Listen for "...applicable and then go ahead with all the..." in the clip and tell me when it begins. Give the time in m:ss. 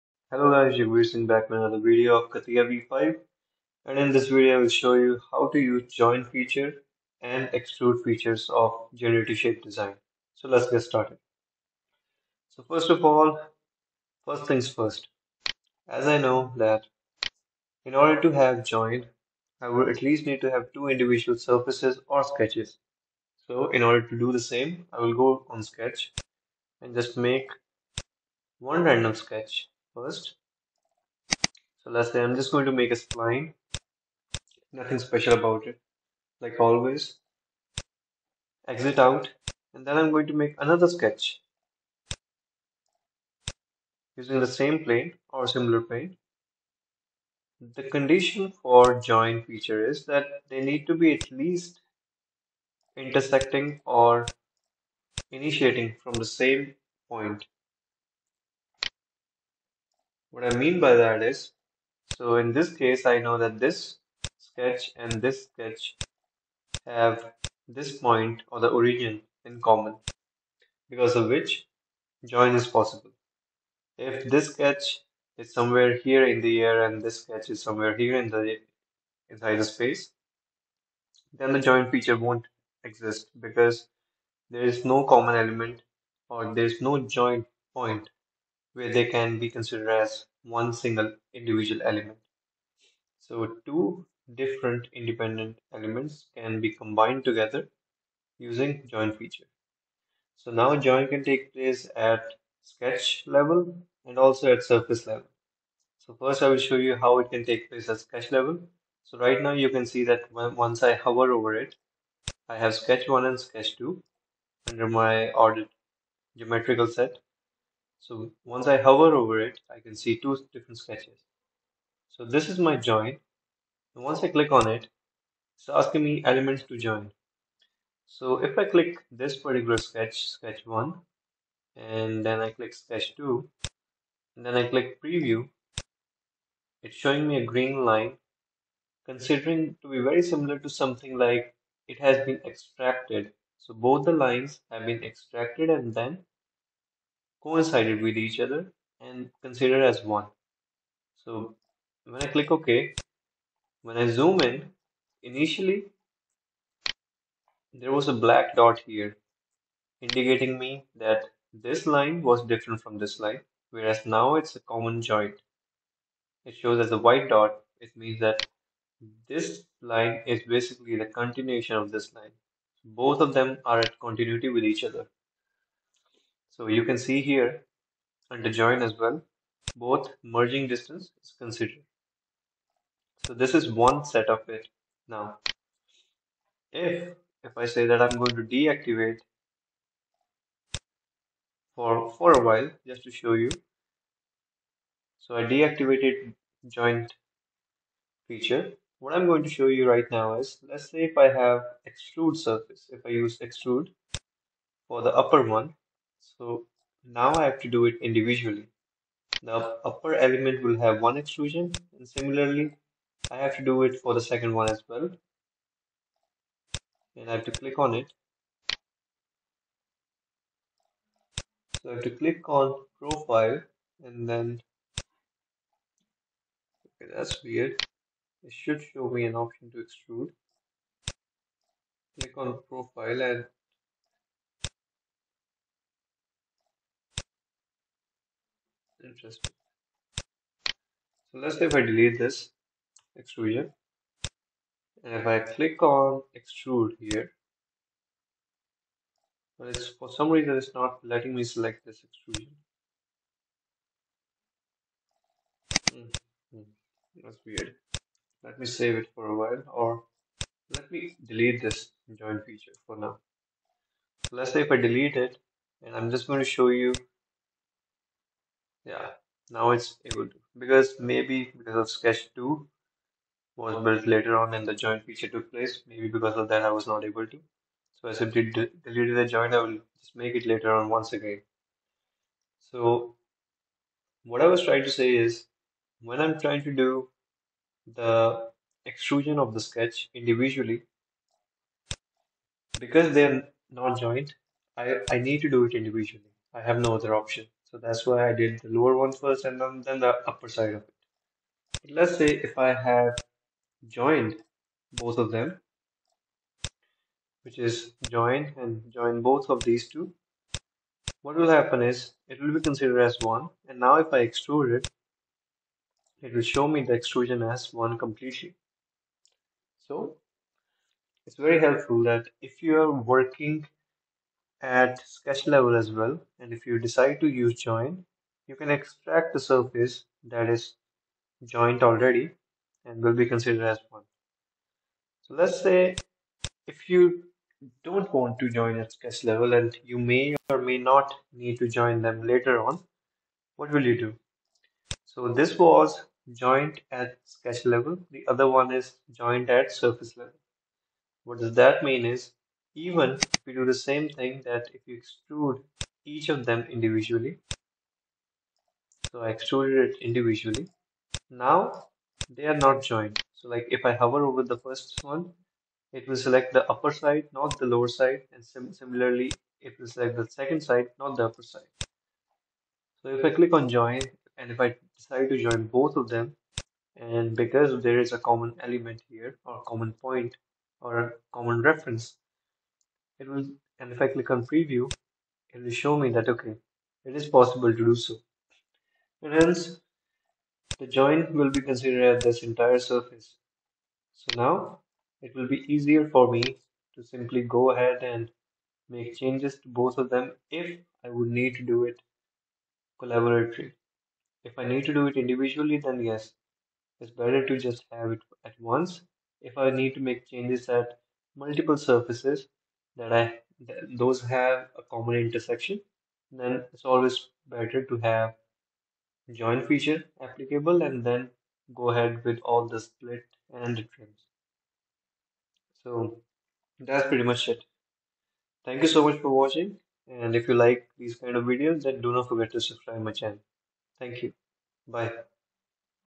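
7:00.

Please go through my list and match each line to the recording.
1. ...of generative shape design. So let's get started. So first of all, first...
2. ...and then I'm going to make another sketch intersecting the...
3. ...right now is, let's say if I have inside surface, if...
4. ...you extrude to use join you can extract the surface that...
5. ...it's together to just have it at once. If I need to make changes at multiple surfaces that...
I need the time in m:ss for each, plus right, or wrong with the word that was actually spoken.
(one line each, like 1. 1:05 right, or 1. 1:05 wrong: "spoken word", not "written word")
1. 0:08 right
2. 0:39 wrong: "using", not "intersecting"
3. 3:19 wrong: "extrude", not "inside"
4. 5:26 wrong: "decide", not "extrude"
5. 6:46 wrong: "better", not "together".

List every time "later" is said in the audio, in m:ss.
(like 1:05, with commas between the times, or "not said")
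4:34, 4:40, 5:42.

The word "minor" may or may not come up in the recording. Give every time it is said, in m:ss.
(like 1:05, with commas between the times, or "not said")
not said.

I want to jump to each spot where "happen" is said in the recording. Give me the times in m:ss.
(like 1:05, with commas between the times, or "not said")
5:11.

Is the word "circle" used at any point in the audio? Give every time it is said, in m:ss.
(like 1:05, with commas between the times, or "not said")
not said.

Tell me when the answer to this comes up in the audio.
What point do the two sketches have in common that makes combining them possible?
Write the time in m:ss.
1:08.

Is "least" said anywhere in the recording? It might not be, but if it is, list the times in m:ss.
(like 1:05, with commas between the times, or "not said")
0:20, 0:51.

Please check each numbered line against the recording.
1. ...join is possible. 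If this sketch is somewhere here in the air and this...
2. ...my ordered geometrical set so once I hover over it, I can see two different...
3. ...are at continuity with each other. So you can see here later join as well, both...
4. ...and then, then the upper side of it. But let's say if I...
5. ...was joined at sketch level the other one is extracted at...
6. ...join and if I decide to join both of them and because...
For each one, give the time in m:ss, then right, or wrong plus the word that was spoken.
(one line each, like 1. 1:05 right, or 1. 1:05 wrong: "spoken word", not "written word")
1. 1:12 right
2. 1:54 right
3. 2:53 wrong: "under", not "later"
4. 4:59 right
5. 5:45 wrong: "joined", not "extracted"
6. 6:13 right.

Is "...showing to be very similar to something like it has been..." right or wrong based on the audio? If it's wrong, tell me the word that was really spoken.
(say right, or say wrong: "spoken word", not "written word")
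wrong: "considering", not "showing".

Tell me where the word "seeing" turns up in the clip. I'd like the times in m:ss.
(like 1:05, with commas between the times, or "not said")
0:01.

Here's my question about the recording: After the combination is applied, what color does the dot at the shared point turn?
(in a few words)
White.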